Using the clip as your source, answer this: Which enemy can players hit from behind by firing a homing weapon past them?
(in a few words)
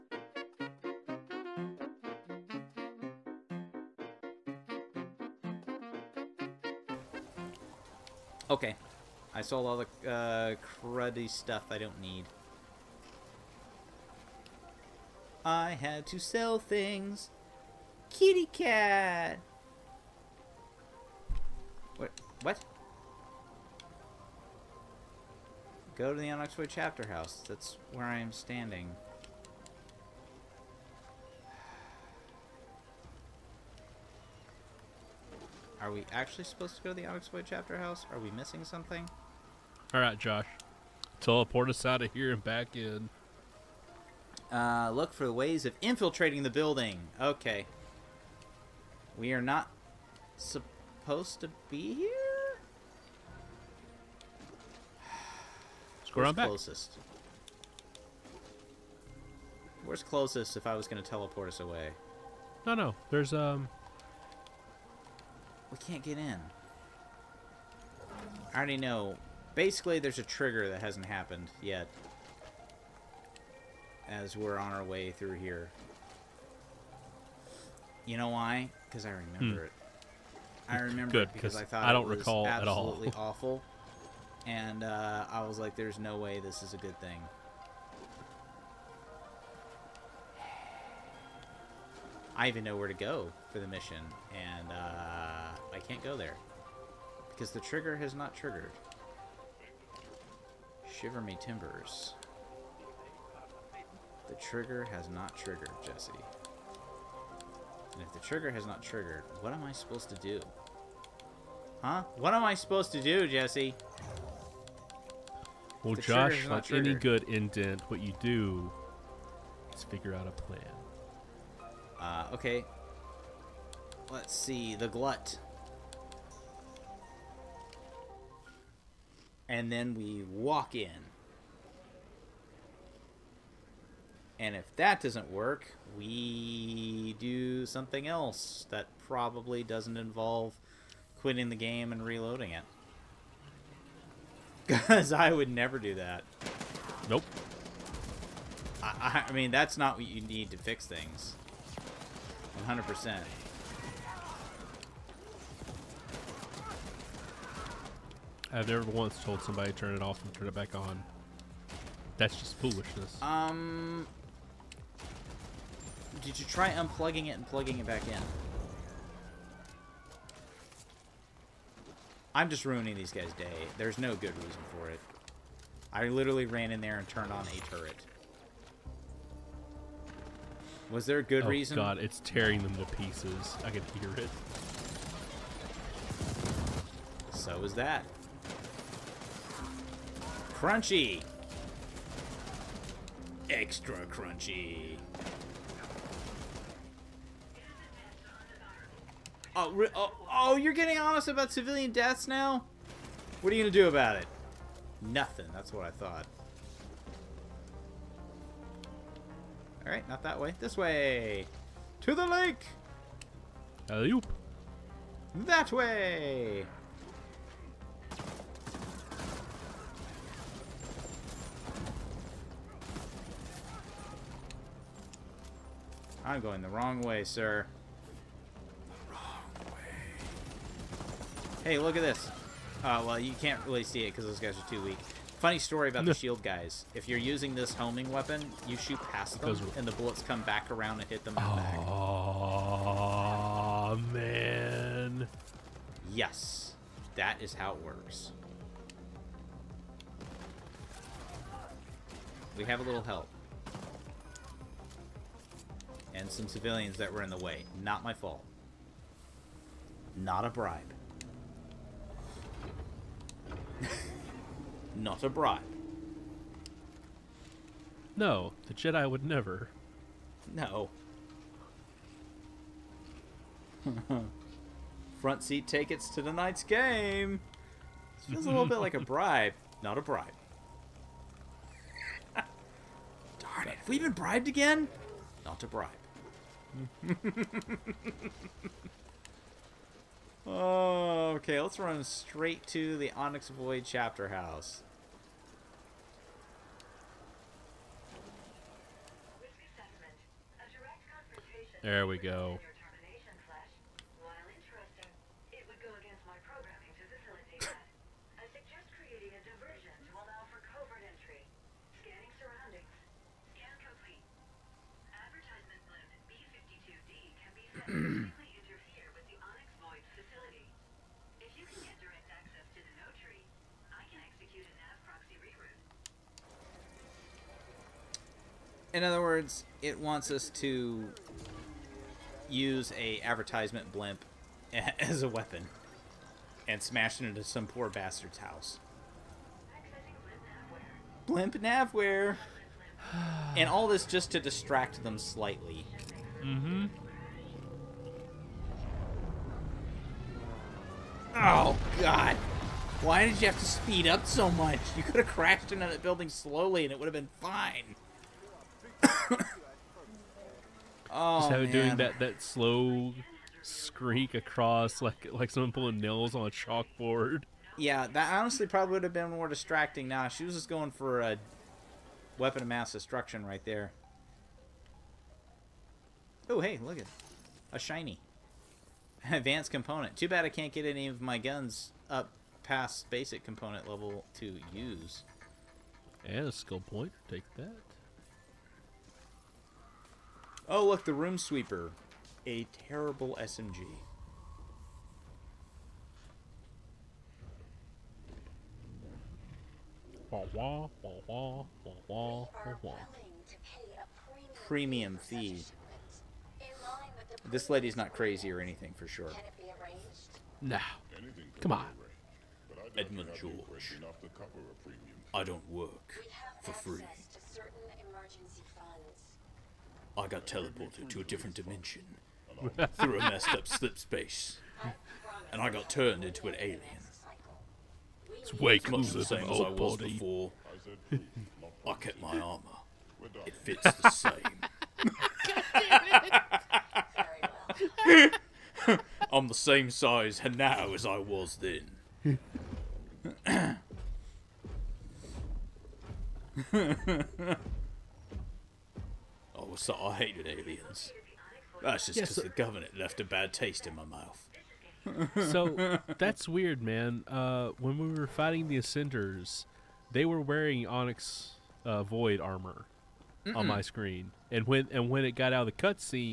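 the shield guys.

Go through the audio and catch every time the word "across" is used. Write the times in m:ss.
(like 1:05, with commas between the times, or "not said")
6:04.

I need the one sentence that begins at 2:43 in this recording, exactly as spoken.
Um, did you try unplugging it and plugging it back in?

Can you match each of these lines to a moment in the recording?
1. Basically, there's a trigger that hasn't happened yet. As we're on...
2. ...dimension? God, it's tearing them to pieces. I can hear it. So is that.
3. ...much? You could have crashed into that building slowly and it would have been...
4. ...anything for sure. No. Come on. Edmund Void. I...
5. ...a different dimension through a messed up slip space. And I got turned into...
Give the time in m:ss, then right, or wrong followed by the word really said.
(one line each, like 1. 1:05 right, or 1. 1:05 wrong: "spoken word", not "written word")
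1. 1:09 right
2. 3:01 wrong: "reason", not "dimension"
3. 5:54 right
4. 6:48 wrong: "George", not "Void"
5. 7:01 right.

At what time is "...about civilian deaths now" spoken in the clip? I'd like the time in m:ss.
3:21.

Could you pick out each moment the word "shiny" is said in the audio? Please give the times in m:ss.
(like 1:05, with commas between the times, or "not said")
6:17.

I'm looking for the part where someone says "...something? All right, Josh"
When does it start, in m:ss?
0:38.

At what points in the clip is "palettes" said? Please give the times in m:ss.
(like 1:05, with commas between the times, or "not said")
not said.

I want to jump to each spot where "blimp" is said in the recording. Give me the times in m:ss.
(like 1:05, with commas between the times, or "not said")
5:33, 5:41.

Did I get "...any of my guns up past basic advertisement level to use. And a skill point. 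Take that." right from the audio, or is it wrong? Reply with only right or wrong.
wrong.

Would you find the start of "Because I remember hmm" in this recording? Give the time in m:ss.
1:18.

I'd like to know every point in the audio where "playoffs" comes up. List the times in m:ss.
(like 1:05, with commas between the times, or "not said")
not said.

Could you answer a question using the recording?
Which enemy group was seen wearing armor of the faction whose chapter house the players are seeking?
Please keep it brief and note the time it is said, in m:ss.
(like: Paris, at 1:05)
the Ascenders, at 7:38.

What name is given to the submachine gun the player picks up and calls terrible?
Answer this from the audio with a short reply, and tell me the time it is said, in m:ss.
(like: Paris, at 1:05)
Room Sweeper, at 6:31.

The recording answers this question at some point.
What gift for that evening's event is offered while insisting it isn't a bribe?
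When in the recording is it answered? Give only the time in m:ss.
4:35.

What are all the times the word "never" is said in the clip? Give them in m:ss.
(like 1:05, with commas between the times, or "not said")
2:25, 2:38, 4:29.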